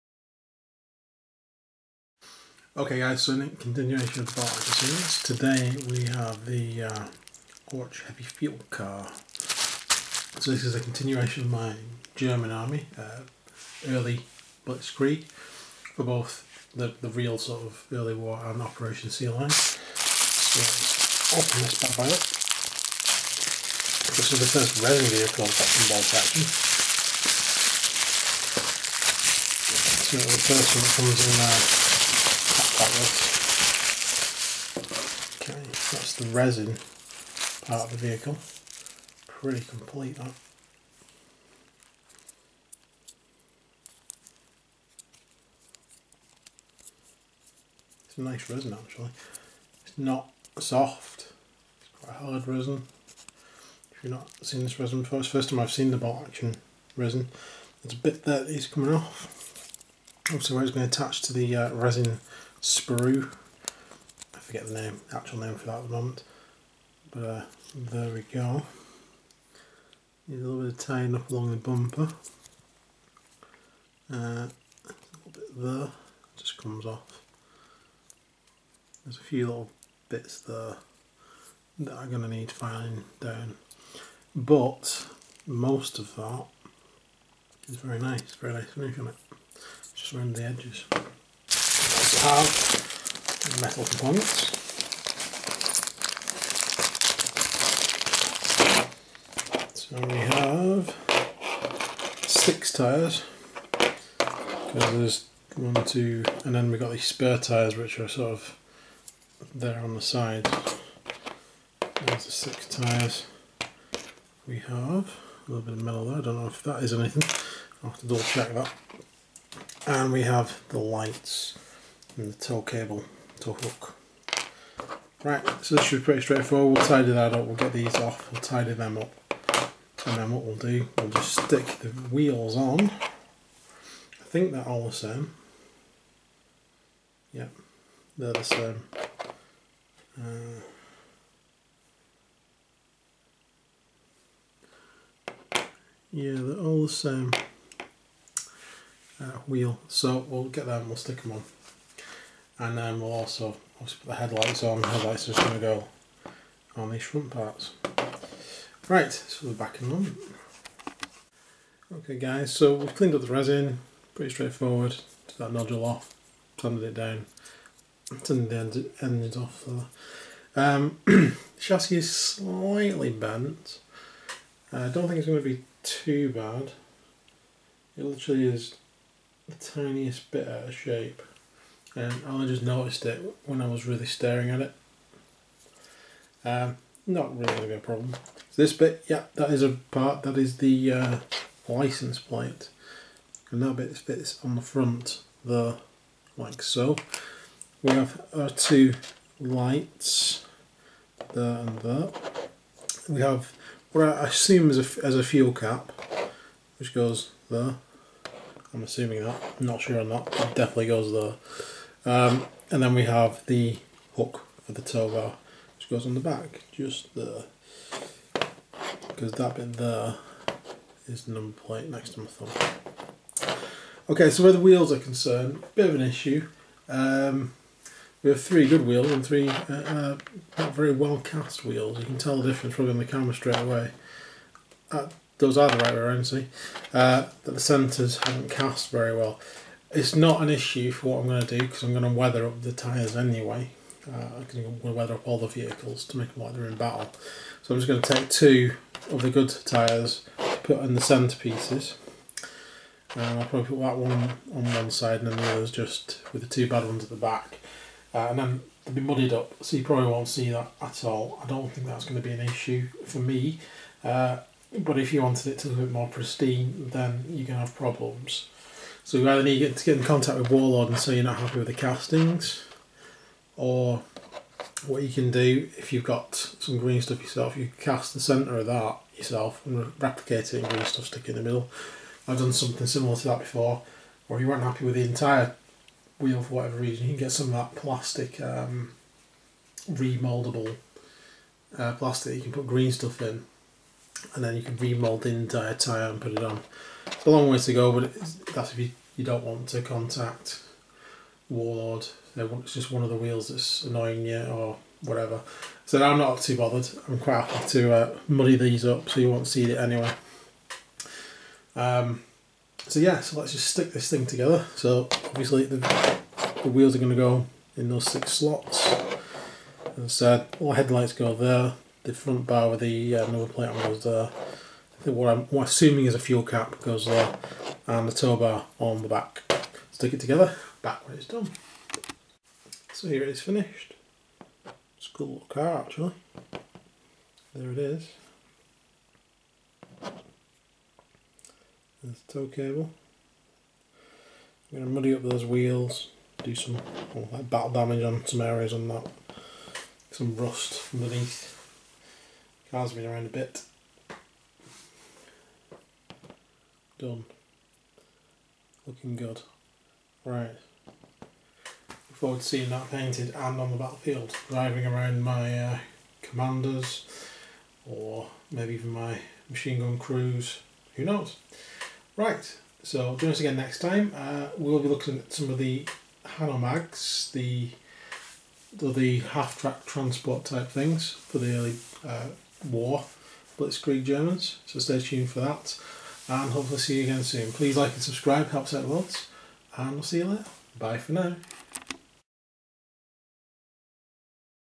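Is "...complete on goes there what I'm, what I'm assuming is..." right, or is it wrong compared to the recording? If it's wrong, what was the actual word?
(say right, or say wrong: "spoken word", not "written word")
wrong: "plate", not "complete".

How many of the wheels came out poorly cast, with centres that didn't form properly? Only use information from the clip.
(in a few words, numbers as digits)
3.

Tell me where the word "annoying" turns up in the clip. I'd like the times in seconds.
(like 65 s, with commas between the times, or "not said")
303 s.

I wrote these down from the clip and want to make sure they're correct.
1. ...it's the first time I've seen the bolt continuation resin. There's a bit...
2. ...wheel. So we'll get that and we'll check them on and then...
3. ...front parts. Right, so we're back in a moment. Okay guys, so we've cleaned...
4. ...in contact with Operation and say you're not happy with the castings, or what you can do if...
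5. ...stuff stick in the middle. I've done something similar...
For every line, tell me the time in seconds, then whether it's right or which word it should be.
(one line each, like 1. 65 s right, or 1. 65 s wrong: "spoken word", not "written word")
1. 55 s wrong: "action", not "continuation"
2. 149 s wrong: "stick", not "check"
3. 157 s right
4. 269 s wrong: "Warlord", not "Operation"
5. 280 s right.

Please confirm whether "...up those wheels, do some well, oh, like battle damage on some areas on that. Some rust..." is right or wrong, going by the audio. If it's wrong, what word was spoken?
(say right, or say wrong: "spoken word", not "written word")
right.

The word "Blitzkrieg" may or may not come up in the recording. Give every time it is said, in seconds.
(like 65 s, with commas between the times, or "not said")
14 s, 383 s.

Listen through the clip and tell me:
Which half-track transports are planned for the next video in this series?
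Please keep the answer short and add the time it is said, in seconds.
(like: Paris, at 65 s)
Hanomags, at 376 s.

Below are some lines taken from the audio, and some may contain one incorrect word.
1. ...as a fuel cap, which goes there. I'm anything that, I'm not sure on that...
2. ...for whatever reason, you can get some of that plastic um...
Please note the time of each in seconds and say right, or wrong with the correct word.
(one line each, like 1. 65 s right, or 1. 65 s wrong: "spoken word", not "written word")
1. 205 s wrong: "assuming", not "anything"
2. 286 s right.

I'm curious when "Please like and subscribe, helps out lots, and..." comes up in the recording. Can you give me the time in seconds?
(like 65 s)
387 s.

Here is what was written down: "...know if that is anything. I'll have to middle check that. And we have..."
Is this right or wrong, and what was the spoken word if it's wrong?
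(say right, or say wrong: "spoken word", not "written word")
wrong: "double", not "middle".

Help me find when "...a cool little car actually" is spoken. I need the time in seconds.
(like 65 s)
335 s.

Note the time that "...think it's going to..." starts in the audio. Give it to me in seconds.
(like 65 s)
175 s.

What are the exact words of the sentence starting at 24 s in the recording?
This is the first resin vehicle I've got involved action.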